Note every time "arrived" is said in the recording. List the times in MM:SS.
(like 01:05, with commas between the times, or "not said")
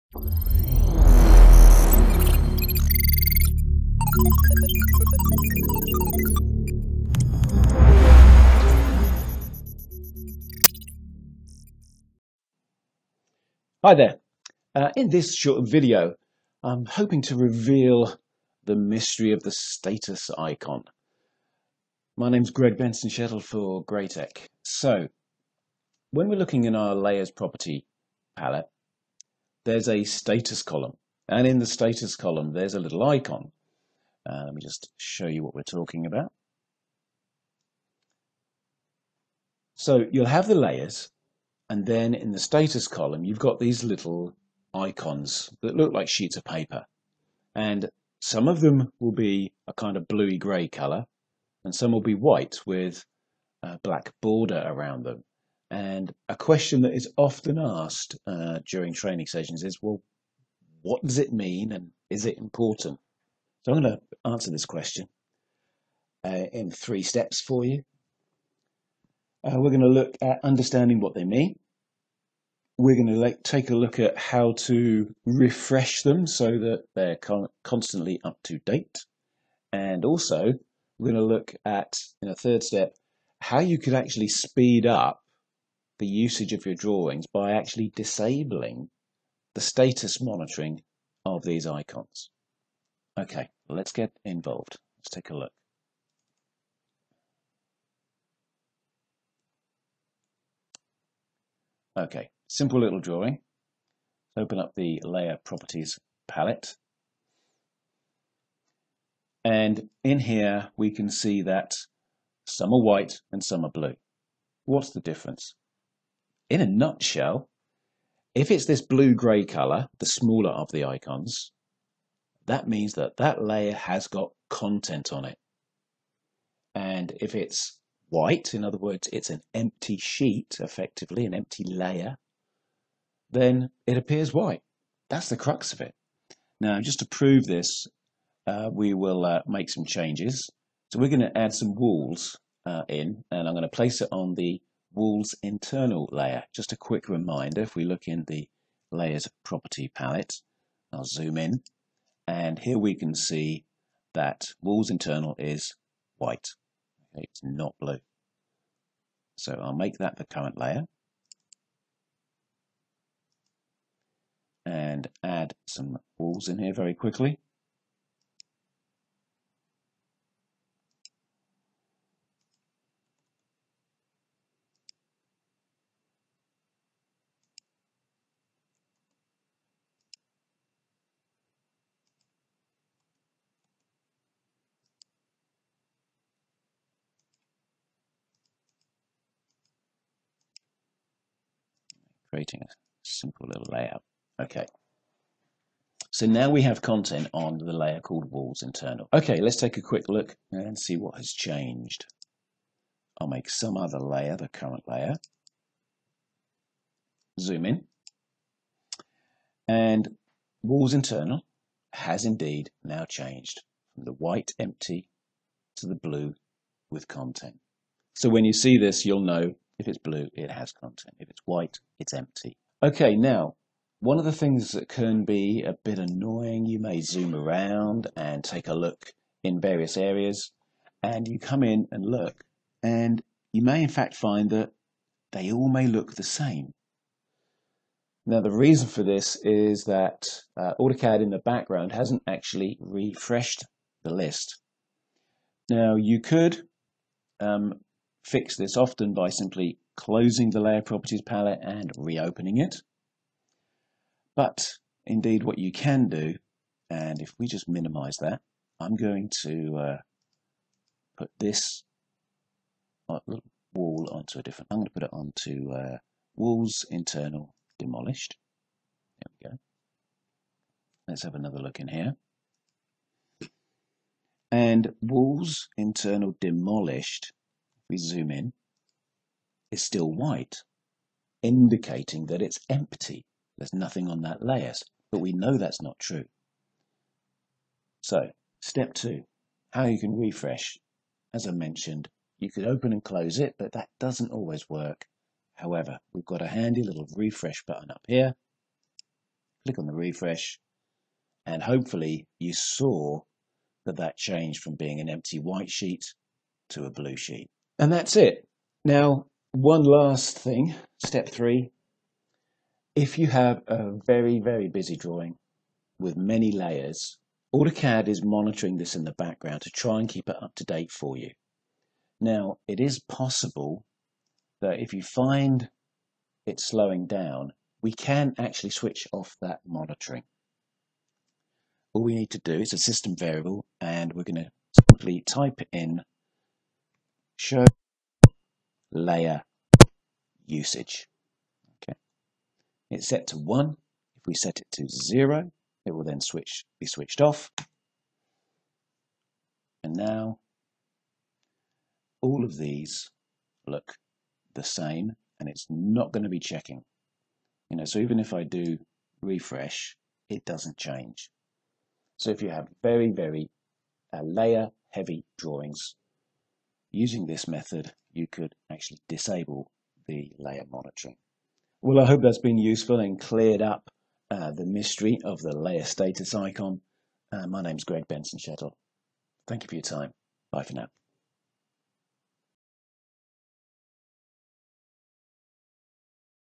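not said.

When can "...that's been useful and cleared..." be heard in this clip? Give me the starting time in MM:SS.
06:12.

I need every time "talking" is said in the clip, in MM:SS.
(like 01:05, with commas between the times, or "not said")
00:35.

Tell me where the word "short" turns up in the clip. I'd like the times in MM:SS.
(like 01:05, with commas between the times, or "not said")
00:15.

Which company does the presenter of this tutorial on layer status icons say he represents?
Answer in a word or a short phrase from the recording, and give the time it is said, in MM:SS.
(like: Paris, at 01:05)
Graitec, at 00:23.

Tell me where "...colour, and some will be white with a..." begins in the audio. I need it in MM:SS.
00:50.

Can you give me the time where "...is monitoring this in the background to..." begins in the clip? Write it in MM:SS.
05:18.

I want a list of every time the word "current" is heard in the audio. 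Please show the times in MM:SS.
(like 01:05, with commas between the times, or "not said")
02:40, 03:24.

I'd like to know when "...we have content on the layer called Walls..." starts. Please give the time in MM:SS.
03:16.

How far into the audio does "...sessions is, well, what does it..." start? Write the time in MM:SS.
00:59.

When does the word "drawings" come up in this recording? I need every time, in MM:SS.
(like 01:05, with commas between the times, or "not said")
01:26, 01:42, 05:14, 06:05.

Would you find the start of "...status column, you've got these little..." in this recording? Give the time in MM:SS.
00:42.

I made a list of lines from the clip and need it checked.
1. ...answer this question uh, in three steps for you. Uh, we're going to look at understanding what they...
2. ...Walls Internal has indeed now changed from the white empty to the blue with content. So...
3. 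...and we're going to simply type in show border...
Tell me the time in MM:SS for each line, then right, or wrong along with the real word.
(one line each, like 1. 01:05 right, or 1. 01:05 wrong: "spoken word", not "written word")
1. 01:04 right
2. 03:30 right
3. 05:33 wrong: "layer", not "border".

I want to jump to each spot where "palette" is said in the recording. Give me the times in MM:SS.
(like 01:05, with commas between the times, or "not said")
00:28, 01:46, 02:29, 04:11.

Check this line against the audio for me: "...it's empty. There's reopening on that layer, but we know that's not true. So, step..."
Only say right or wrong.
wrong.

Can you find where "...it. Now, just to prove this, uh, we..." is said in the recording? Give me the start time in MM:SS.
02:15.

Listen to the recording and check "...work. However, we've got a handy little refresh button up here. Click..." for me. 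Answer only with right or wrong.
right.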